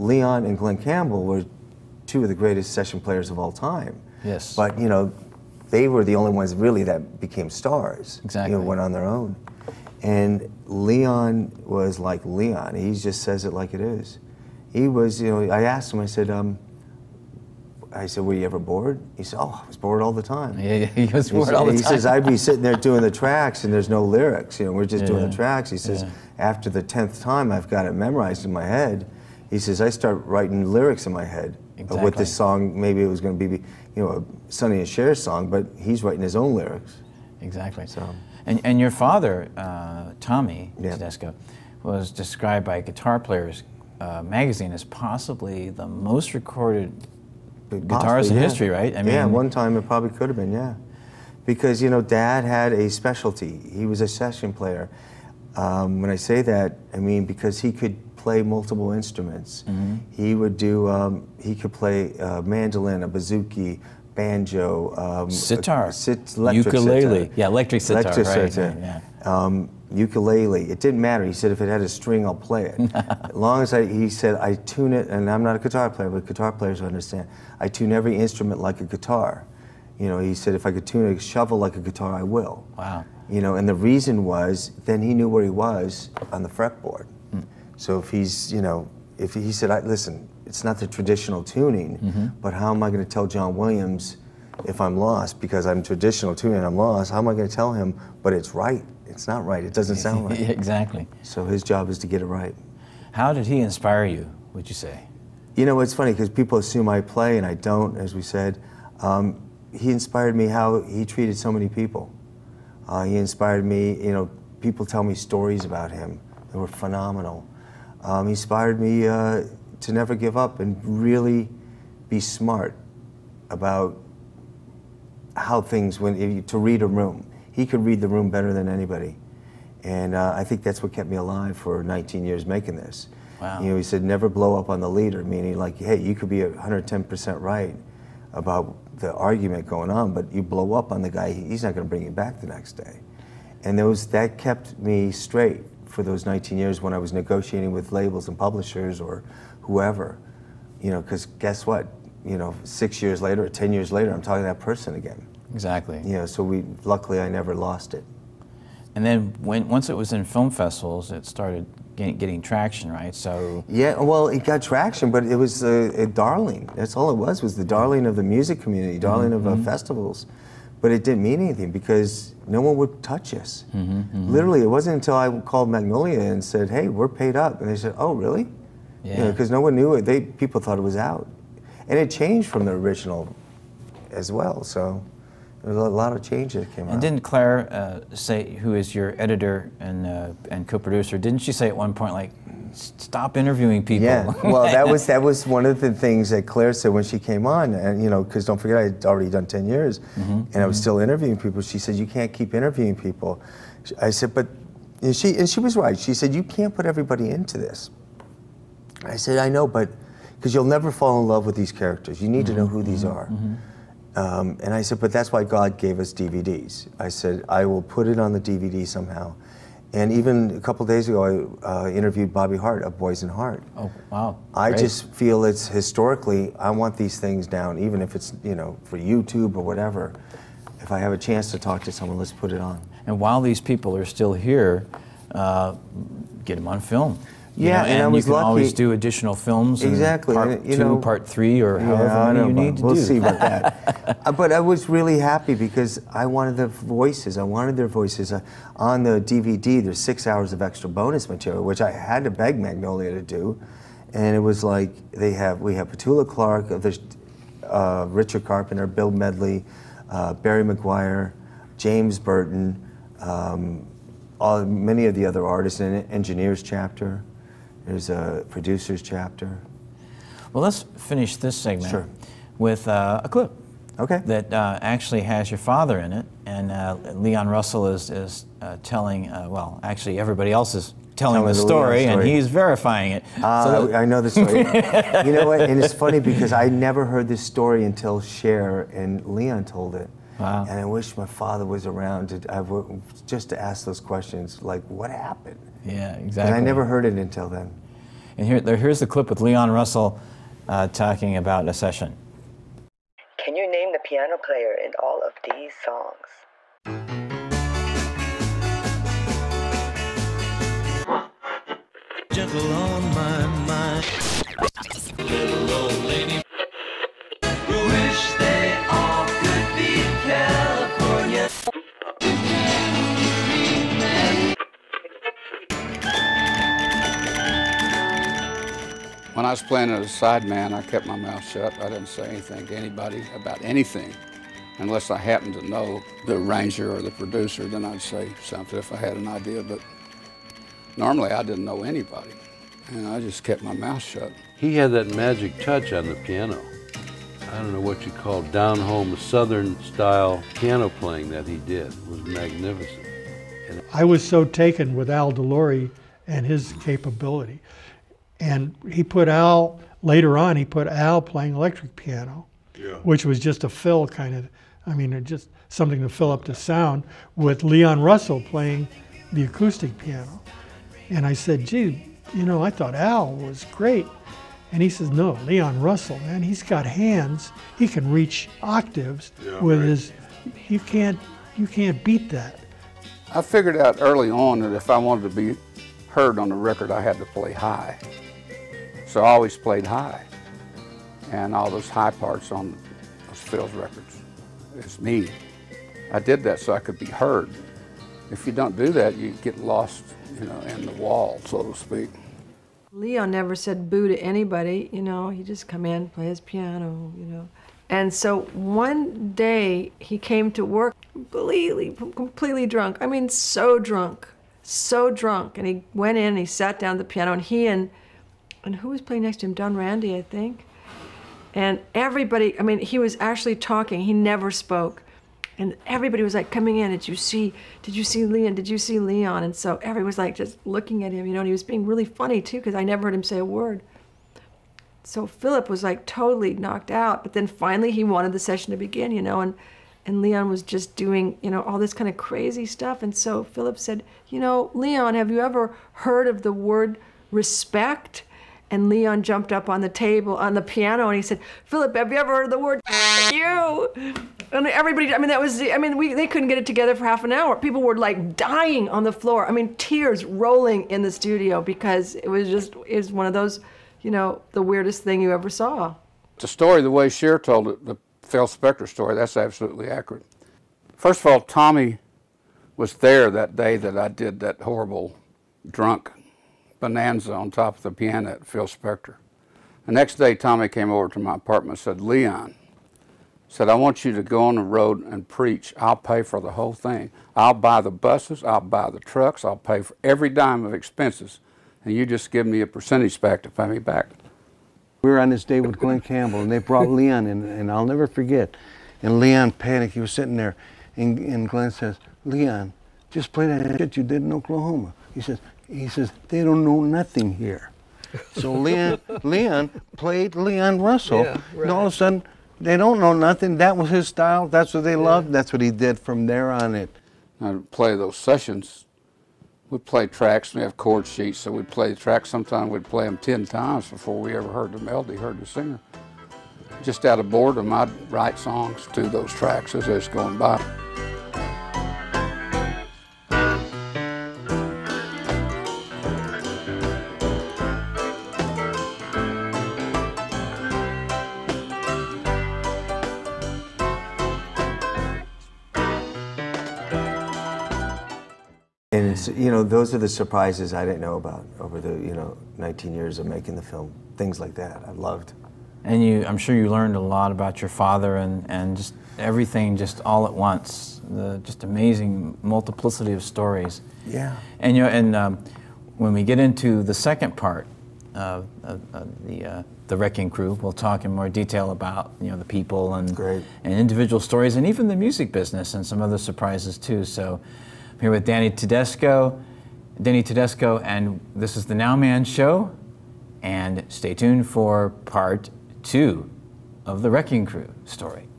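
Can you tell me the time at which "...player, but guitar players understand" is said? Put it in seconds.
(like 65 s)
75 s.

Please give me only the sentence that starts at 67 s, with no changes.
yeah, electric sitar, electric right, sitar.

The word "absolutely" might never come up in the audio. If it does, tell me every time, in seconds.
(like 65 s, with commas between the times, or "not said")
469 s.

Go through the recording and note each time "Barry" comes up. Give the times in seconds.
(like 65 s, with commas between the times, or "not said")
260 s.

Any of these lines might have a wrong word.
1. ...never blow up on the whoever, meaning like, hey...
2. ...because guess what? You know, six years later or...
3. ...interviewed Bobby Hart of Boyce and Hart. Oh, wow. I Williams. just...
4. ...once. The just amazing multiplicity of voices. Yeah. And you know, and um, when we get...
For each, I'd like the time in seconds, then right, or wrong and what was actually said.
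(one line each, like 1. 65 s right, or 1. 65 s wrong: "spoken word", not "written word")
1. 134 s wrong: "leader", not "whoever"
2. 151 s right
3. 221 s wrong: "Great", not "Williams"
4. 560 s wrong: "stories", not "voices".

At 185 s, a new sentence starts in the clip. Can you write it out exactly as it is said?
There's a lot of changes came and out.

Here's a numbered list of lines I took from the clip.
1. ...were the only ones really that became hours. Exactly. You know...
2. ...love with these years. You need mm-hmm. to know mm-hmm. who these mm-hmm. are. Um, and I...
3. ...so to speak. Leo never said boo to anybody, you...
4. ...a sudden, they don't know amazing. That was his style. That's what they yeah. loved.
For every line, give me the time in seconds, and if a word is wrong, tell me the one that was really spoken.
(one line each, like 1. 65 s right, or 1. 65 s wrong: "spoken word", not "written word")
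1. 5 s wrong: "stars", not "hours"
2. 211 s wrong: "characters", not "years"
3. 401 s right
4. 511 s wrong: "nothing", not "amazing".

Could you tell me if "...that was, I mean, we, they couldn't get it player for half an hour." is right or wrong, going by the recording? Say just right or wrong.
wrong.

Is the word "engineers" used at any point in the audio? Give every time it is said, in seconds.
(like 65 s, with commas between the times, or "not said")
266 s.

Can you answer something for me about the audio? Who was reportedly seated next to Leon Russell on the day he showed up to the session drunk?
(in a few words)
Don Randi.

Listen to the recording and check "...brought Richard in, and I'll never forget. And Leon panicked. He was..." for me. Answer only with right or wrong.
wrong.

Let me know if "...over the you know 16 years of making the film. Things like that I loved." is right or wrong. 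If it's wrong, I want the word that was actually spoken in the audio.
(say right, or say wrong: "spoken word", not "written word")
wrong: "19", not "16".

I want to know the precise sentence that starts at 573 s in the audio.
and individual stories and even the music business and some other surprises too.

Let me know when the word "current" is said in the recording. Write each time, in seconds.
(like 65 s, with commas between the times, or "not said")
not said.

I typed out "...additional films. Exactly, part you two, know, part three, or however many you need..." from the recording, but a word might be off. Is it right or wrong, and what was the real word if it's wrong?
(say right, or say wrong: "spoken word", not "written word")
right.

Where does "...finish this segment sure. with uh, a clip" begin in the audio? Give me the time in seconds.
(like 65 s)
270 s.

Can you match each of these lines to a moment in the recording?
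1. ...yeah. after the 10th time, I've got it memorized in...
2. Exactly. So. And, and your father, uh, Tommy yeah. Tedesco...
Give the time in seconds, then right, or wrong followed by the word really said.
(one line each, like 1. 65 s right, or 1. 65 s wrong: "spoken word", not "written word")
1. 26 s right
2. 37 s right.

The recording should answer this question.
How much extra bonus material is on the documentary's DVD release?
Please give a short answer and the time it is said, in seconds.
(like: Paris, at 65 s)
6 hours, at 249 s.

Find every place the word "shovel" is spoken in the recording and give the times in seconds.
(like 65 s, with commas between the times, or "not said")
81 s.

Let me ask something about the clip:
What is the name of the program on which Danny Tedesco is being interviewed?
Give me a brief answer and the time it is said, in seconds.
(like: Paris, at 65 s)
Now Man Show, at 581 s.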